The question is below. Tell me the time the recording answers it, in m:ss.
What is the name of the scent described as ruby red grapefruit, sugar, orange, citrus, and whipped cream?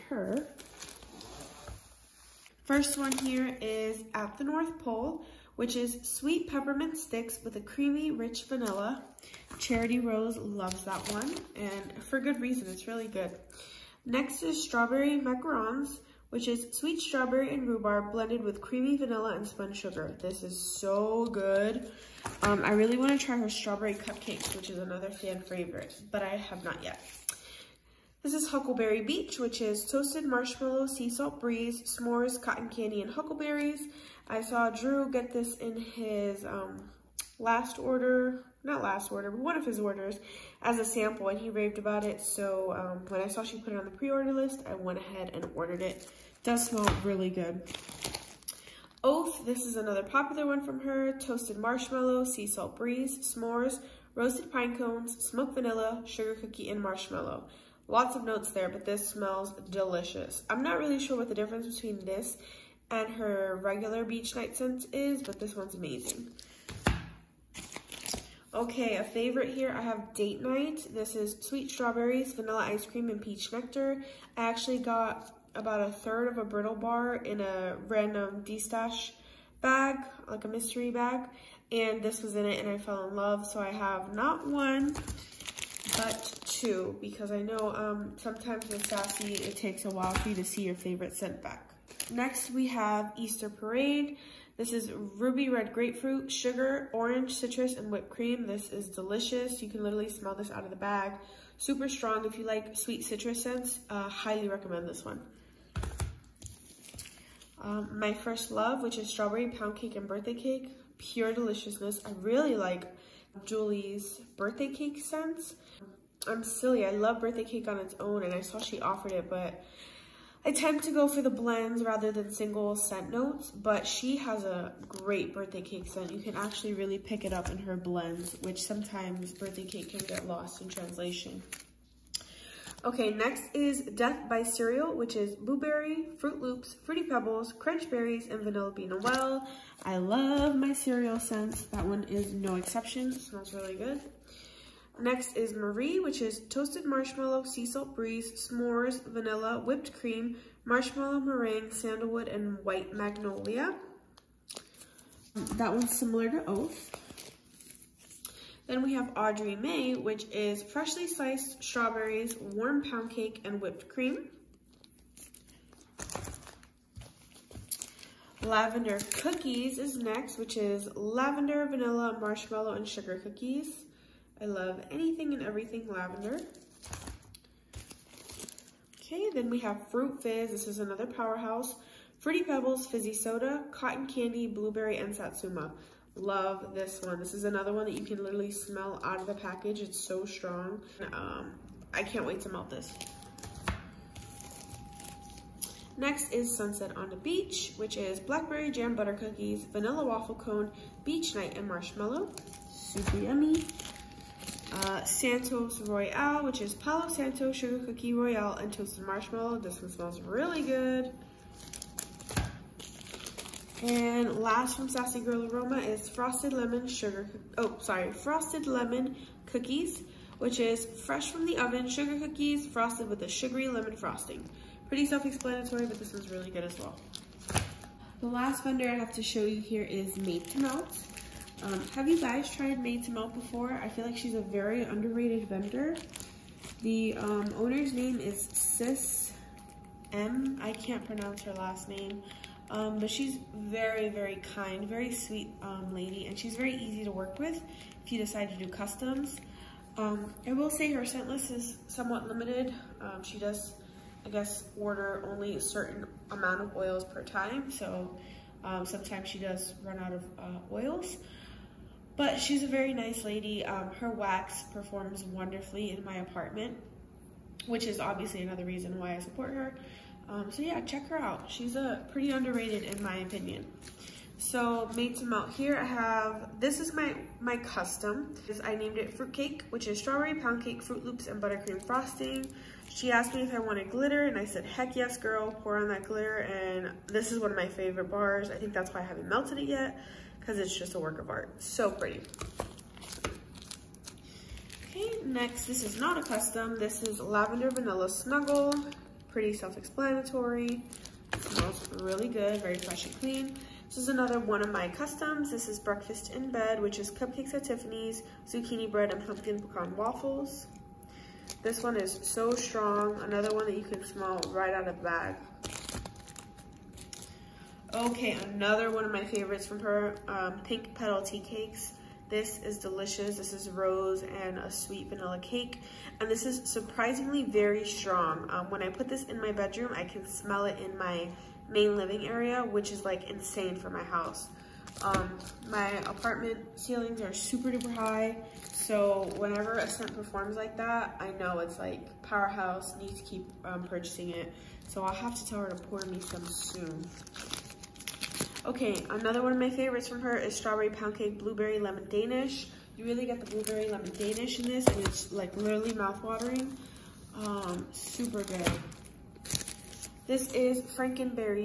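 1:33.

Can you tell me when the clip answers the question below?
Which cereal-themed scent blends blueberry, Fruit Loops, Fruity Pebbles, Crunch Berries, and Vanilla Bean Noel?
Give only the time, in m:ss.
2:13.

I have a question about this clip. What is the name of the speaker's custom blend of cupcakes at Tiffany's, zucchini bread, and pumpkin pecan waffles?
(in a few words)
Breakfast in Bed.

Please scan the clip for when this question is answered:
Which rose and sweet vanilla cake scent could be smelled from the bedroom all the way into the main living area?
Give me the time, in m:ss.
5:20.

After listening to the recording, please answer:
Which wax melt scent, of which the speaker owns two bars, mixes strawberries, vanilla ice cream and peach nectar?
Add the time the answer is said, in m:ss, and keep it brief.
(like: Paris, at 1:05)
Date Night, at 1:10.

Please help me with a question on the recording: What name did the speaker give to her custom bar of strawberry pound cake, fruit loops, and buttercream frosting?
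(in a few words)
Fruit Cake.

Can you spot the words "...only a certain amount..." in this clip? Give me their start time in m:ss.
4:15.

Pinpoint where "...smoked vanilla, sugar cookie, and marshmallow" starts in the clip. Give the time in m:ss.
0:55.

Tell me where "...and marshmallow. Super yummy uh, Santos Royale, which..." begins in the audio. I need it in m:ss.
3:21.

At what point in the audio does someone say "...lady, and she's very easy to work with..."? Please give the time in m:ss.
4:05.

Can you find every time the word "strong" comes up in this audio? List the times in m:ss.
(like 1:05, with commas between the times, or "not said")
1:41, 3:10, 5:12, 5:27.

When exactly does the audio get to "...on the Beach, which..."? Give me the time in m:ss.
3:16.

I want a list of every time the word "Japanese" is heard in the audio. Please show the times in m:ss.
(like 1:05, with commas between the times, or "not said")
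not said.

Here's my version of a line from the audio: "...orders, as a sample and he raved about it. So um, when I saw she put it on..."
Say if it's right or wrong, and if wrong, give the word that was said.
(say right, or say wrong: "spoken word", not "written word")
right.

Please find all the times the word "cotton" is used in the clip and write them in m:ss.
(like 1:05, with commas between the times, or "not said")
0:32, 3:03.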